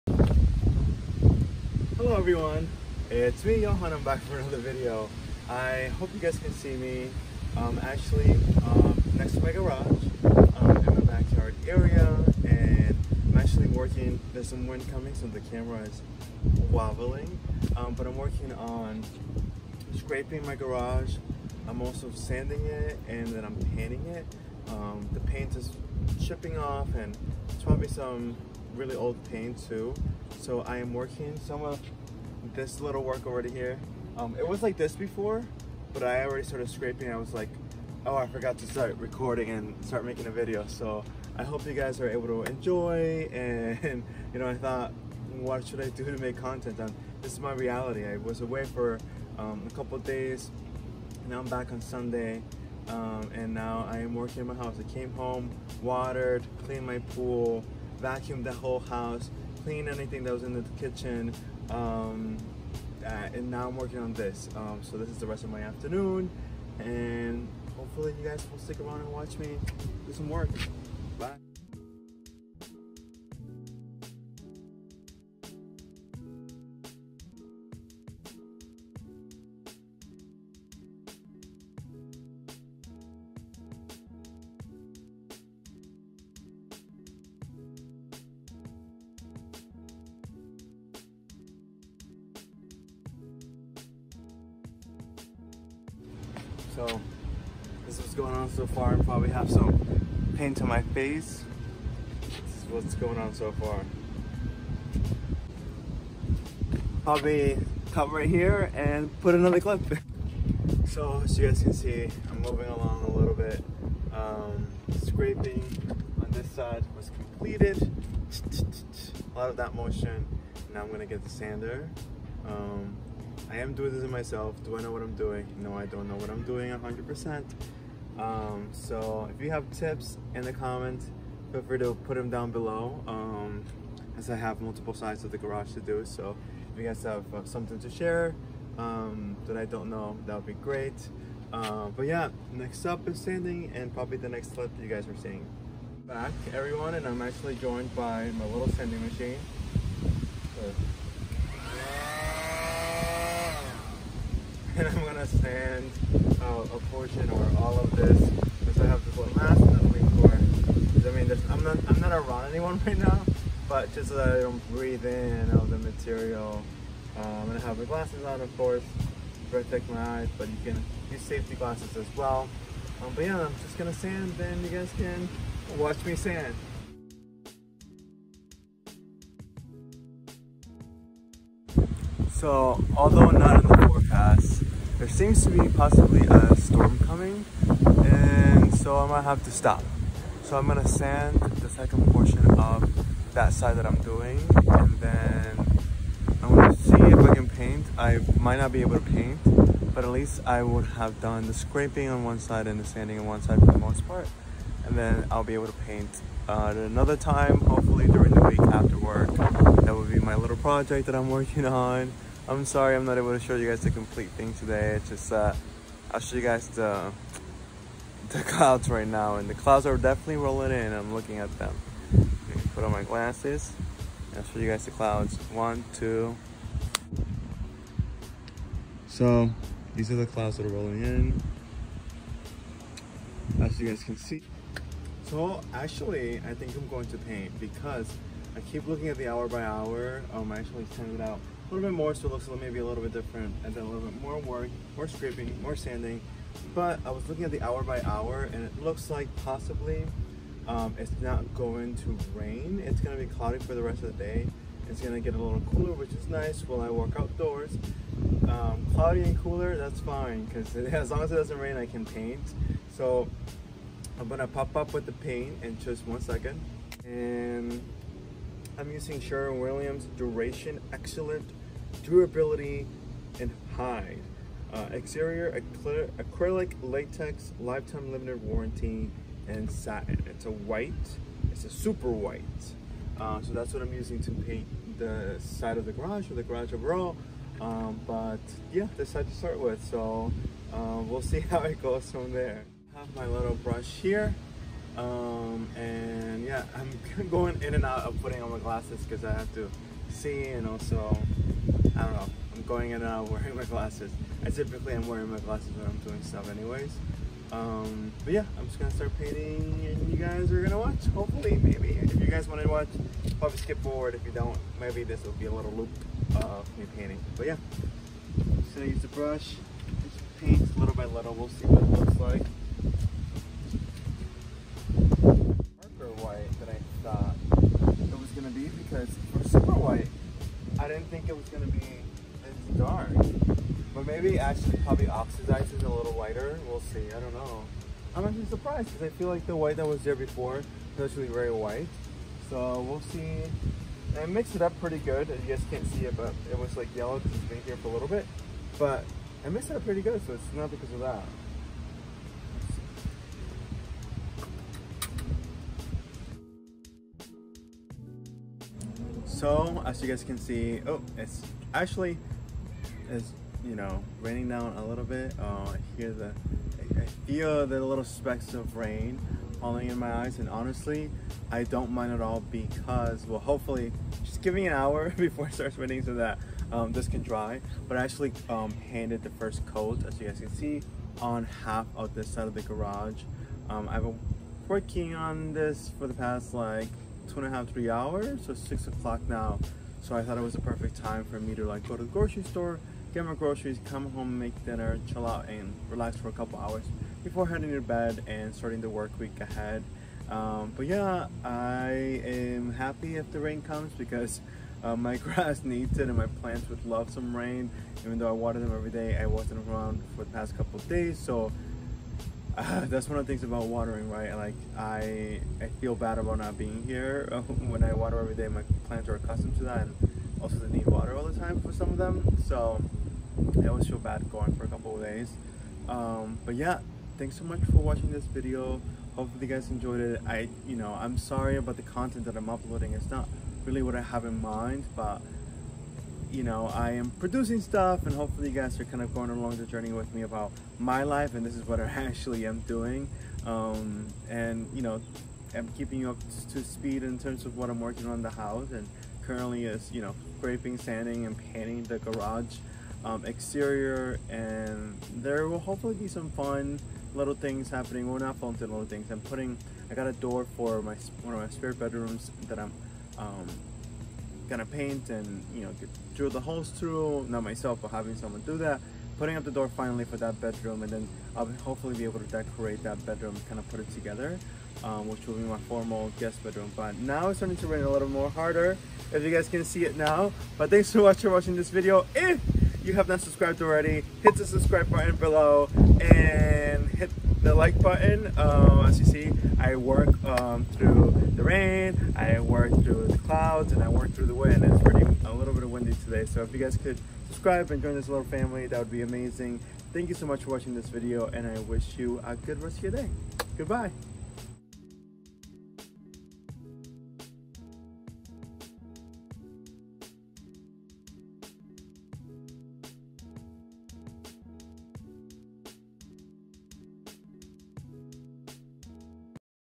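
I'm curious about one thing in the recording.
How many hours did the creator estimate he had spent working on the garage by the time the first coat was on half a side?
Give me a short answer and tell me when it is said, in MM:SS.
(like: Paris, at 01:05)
2.5 to 3 hours, at 06:27.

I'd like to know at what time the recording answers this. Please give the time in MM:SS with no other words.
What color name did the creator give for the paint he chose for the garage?
04:41.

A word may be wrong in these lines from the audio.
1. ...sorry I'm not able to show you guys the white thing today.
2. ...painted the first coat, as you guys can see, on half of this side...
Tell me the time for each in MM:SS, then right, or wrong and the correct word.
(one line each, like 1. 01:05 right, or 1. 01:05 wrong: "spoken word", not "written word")
1. 03:32 wrong: "complete", not "white"
2. 06:18 right.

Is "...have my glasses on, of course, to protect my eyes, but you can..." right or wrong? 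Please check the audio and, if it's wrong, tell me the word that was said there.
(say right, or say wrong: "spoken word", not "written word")
right.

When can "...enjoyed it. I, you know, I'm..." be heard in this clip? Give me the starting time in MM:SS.
07:09.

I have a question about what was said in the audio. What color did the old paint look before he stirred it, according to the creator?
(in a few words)
Yellow.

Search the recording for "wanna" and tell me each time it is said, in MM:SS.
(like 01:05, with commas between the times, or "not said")
05:12.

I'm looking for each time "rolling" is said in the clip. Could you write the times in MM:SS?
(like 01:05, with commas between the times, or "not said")
03:40, 03:50.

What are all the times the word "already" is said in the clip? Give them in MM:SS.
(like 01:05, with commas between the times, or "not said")
00:36, 08:03.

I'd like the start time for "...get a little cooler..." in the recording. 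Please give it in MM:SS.
04:15.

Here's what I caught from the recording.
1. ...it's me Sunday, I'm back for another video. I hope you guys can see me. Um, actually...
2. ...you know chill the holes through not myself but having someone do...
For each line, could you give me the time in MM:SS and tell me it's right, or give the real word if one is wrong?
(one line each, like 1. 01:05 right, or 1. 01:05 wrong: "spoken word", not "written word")
1. 00:03 wrong: "Johan", not "Sunday"
2. 07:45 wrong: "drill", not "chill".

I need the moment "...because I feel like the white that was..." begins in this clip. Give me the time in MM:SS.
05:38.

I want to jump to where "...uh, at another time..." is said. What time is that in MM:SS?
03:26.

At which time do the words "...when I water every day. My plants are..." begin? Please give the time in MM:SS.
06:57.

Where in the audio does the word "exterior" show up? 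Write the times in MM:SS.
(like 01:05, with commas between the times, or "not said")
04:34, 07:33.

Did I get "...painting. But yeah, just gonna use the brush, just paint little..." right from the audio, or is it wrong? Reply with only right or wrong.
right.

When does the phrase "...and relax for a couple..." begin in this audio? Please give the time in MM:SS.
06:35.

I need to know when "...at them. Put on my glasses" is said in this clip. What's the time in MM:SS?
03:41.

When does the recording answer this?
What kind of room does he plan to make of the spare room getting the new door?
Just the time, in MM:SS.
07:55.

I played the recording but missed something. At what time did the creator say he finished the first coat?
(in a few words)
6:00.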